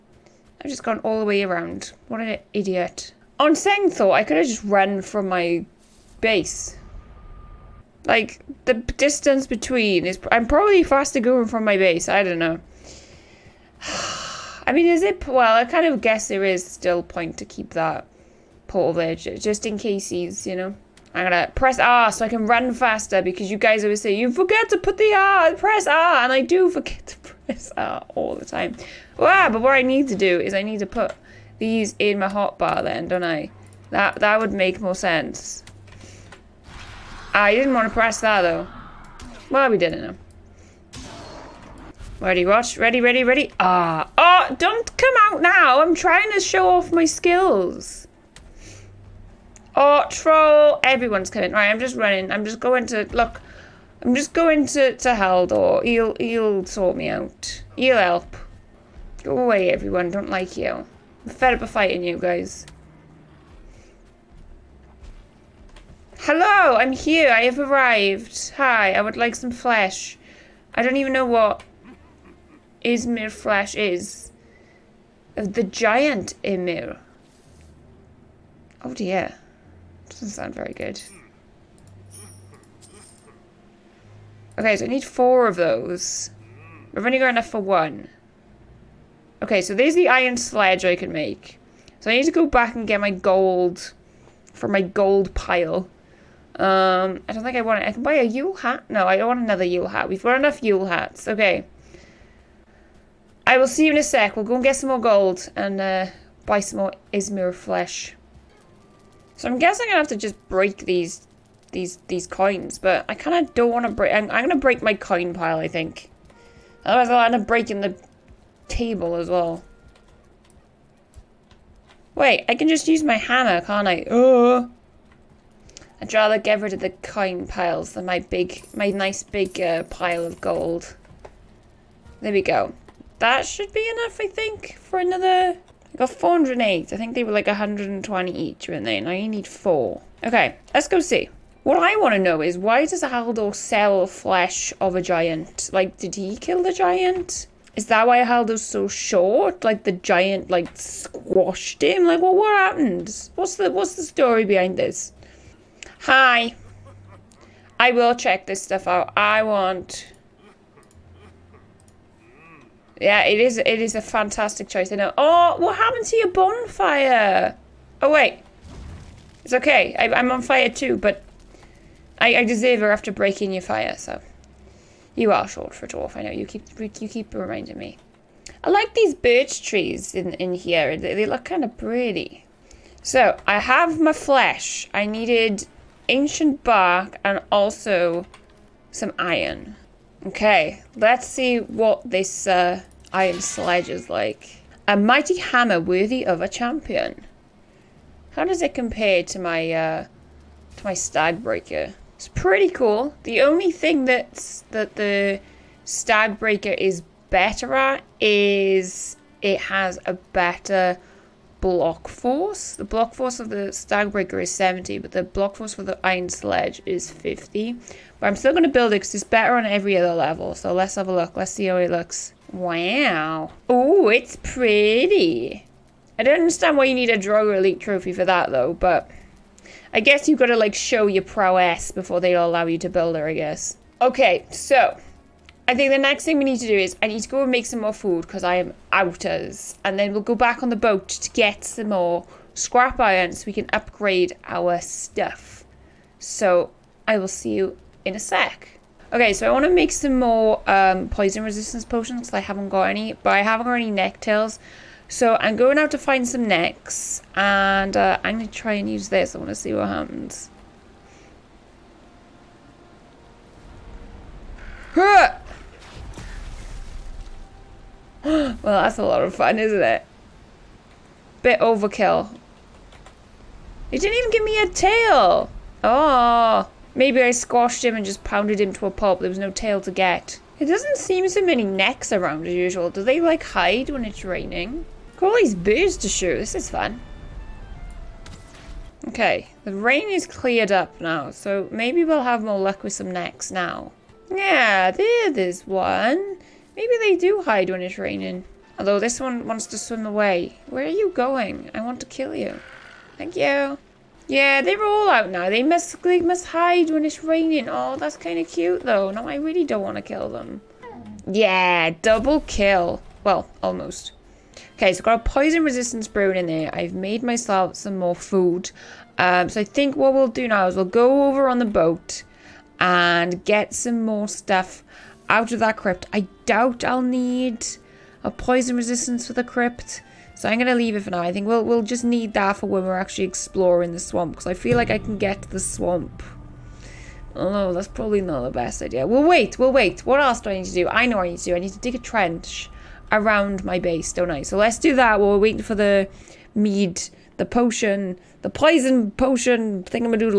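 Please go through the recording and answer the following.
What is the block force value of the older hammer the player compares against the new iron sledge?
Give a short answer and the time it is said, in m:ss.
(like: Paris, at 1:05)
70, at 3:34.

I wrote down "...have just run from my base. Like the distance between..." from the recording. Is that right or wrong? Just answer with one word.
right.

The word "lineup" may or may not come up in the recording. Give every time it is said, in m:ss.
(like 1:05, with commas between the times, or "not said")
not said.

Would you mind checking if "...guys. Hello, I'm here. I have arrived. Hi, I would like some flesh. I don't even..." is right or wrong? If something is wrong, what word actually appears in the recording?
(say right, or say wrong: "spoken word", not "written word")
right.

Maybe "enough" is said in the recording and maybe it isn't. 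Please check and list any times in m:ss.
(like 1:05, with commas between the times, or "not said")
1:27, 1:40, 2:13.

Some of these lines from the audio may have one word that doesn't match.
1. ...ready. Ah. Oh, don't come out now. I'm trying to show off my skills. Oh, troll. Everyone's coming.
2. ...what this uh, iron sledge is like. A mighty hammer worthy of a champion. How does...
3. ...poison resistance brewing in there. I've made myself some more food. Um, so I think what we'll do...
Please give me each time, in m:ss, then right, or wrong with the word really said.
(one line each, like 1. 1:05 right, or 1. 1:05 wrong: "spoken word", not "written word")
1. 0:43 right
2. 3:11 right
3. 5:15 right.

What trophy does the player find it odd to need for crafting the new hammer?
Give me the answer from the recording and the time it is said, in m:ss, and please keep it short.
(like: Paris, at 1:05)
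Draugr Elite Trophy, at 3:47.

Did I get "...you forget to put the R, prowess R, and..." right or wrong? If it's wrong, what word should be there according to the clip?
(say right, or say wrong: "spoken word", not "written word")
wrong: "press", not "prowess".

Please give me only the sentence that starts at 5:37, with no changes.
Although that's probably not the best idea.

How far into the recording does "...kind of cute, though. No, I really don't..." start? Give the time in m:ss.
5:08.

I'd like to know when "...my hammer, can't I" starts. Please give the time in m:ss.
2:03.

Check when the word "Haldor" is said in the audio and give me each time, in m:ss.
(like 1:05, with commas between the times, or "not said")
0:55, 2:23, 2:28.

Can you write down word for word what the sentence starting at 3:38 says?
But I'm still going to build it because it's better on every other level.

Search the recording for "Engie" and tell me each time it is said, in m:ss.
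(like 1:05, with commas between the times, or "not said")
not said.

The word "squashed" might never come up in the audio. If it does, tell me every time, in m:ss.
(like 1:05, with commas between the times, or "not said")
2:30, 4:37.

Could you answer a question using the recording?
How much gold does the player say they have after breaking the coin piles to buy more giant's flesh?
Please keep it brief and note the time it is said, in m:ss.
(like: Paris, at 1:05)
408, at 2:16.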